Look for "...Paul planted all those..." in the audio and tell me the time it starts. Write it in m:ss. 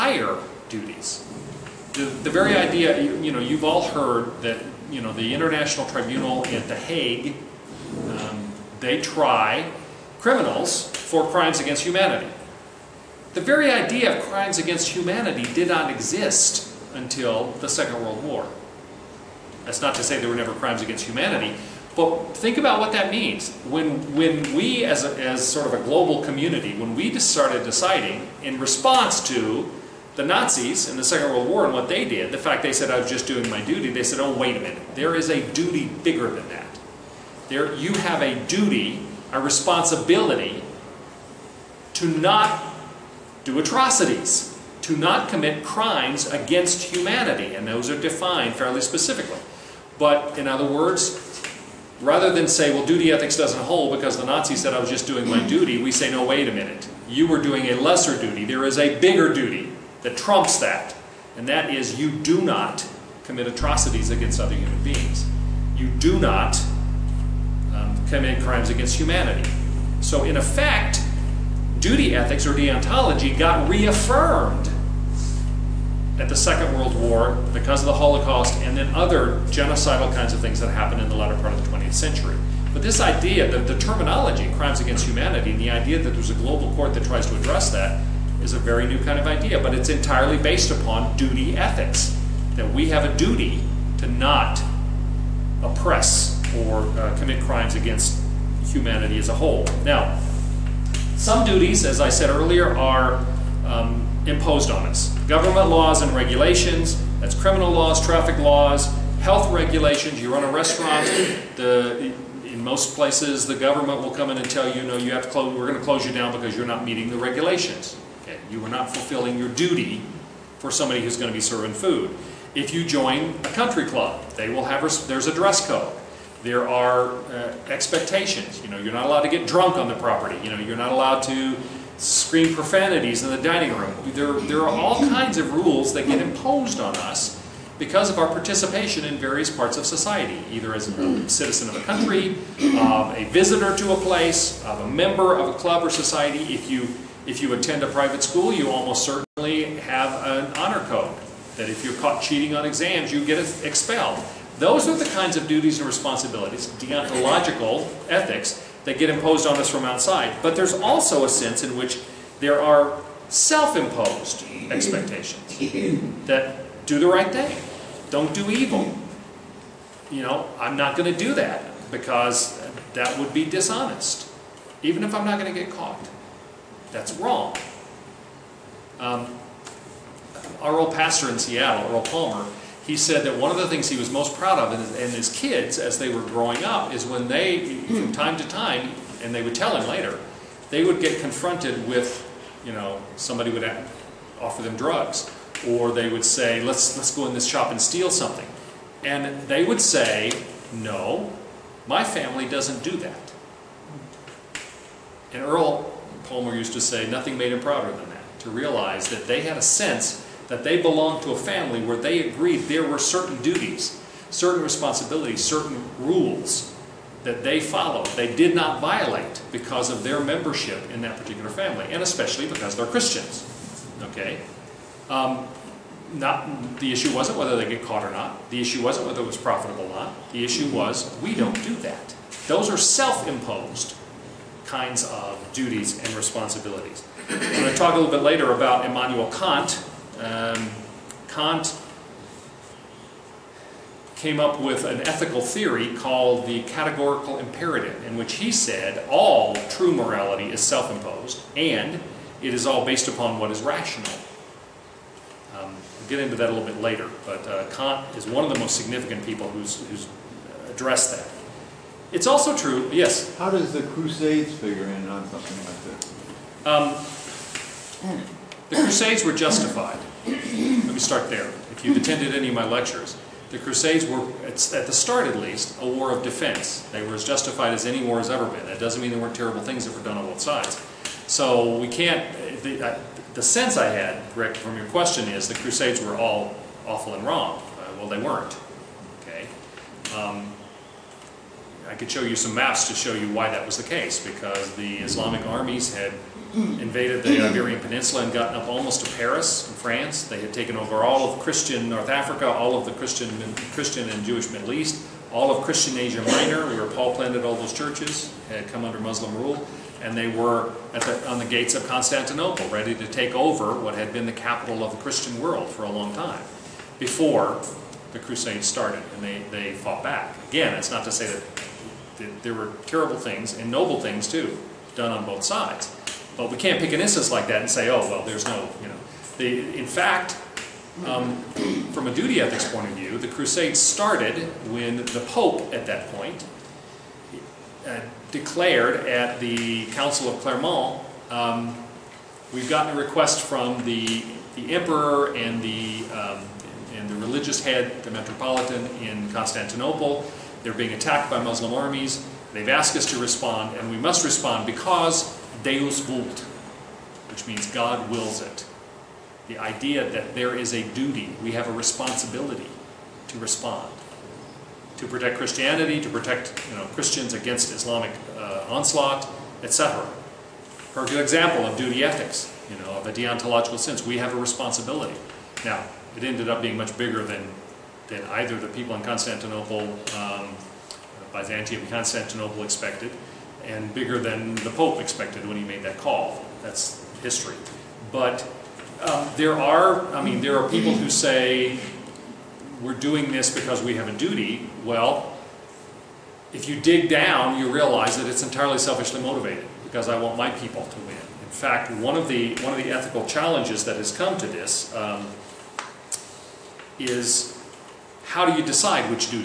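5:06.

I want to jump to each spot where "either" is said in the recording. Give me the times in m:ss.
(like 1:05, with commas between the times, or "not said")
2:20, 6:18.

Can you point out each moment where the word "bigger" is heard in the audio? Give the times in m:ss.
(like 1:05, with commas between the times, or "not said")
0:36, 0:58, 6:16, 6:23.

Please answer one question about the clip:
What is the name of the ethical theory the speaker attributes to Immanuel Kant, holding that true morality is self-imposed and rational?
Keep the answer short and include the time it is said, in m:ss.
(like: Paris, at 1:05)
categorical imperative, at 4:06.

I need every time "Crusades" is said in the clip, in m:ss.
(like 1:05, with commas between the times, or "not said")
4:23, 4:28, 4:33, 4:45, 5:18, 5:33.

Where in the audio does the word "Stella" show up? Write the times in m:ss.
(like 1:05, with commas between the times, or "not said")
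not said.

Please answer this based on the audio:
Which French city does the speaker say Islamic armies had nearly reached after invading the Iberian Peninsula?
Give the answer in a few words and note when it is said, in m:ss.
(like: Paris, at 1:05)
Paris, at 4:59.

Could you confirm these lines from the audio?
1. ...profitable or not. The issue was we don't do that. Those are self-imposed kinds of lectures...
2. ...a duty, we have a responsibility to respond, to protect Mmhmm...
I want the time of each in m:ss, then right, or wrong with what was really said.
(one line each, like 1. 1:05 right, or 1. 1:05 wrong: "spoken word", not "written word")
1. 3:49 wrong: "duties", not "lectures"
2. 6:00 wrong: "Christianity", not "Mmhmm".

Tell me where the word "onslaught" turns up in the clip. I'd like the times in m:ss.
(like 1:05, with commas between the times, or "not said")
6:08.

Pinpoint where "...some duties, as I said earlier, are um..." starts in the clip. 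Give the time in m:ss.
1:41.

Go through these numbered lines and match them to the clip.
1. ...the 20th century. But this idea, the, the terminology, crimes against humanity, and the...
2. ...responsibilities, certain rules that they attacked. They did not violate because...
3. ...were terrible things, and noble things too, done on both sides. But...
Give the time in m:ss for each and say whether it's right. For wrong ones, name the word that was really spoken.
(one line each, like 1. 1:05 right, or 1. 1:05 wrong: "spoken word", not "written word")
1. 1:21 right
2. 3:34 wrong: "followed", not "attacked"
3. 5:22 right.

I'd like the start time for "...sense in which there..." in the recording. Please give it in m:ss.
2:41.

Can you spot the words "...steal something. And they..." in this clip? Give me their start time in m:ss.
3:17.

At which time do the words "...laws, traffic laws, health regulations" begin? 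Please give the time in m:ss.
1:47.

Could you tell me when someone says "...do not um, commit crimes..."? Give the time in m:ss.
1:05.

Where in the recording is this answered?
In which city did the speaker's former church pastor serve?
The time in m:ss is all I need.
3:01.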